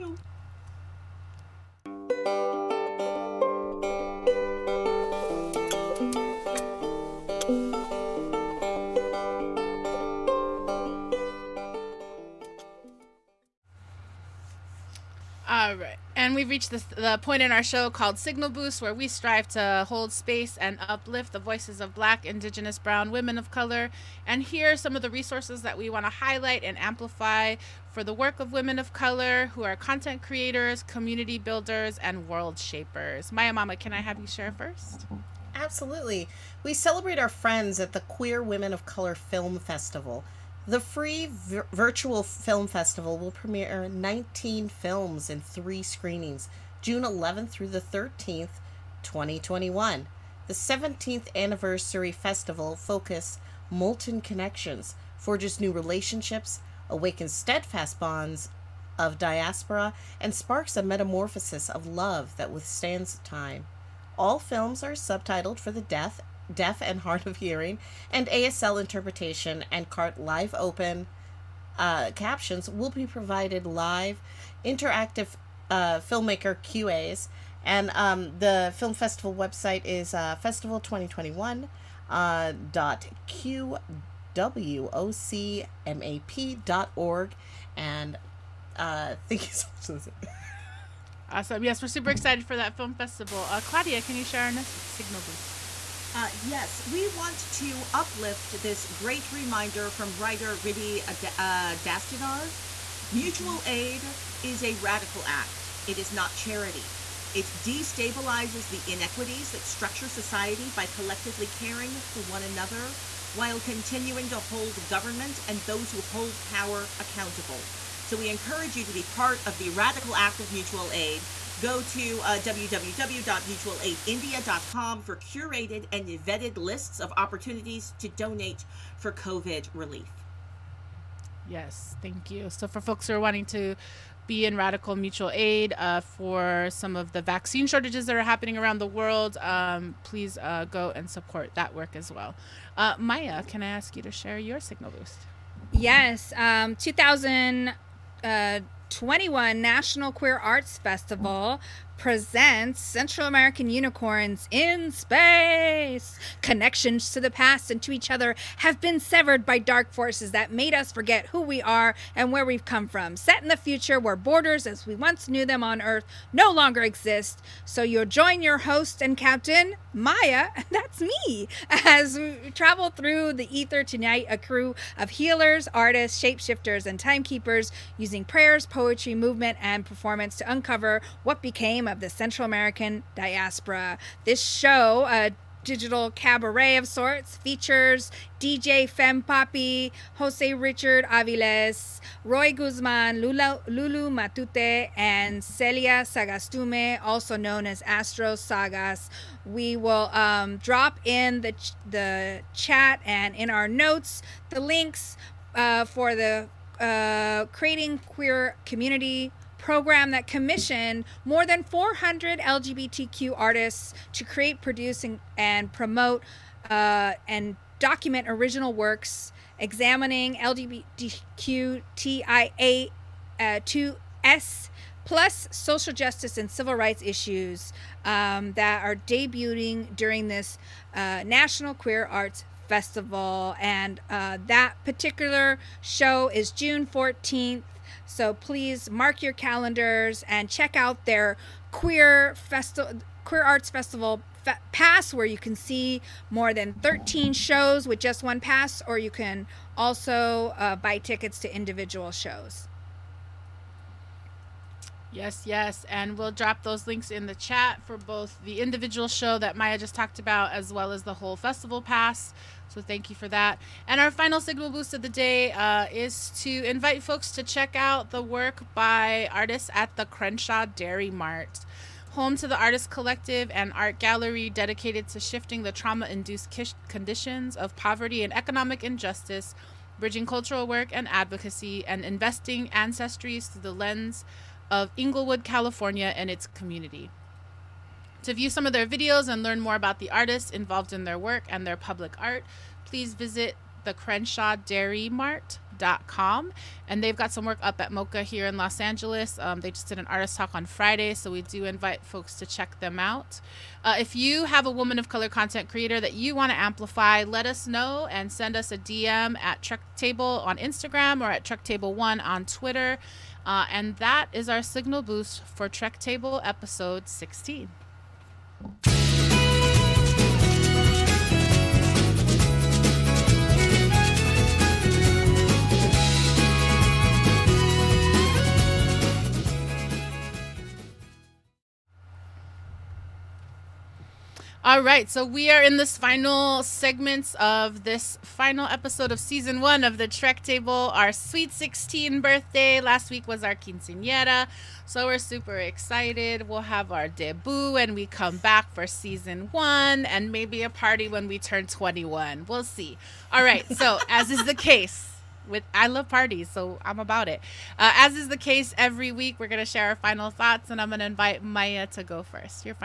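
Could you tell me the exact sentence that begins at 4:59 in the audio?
Um, they just did an artist talk on Friday, so we do invite folks to check them out.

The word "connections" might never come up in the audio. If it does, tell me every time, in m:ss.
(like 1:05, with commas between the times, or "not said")
0:54, 2:36.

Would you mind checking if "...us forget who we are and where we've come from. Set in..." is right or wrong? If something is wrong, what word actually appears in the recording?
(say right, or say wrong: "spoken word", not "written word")
right.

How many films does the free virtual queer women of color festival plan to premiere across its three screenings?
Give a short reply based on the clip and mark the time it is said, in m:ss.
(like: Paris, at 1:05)
19, at 0:43.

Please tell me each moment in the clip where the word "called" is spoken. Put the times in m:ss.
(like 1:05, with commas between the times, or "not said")
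0:17.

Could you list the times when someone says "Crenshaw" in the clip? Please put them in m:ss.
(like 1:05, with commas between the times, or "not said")
4:30, 4:53.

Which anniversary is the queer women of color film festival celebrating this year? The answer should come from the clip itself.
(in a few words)
17th.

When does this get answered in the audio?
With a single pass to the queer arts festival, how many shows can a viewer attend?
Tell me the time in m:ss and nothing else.
4:06.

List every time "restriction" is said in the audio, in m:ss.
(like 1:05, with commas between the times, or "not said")
not said.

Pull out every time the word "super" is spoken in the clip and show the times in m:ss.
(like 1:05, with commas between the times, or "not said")
1:31, 5:45.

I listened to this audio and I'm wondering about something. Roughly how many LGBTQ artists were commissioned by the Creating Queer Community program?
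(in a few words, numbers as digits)
400.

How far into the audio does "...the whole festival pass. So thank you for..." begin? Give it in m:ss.
4:21.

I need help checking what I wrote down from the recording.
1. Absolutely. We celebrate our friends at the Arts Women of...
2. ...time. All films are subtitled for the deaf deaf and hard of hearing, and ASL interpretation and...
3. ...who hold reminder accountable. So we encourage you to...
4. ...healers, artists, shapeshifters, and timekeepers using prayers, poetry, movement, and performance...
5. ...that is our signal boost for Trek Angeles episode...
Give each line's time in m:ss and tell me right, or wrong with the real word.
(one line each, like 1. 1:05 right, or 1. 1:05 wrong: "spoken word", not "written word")
1. 0:35 wrong: "Queer", not "Arts"
2. 1:03 right
3. 1:55 wrong: "power", not "reminder"
4. 2:55 right
5. 5:13 wrong: "Table", not "Angeles".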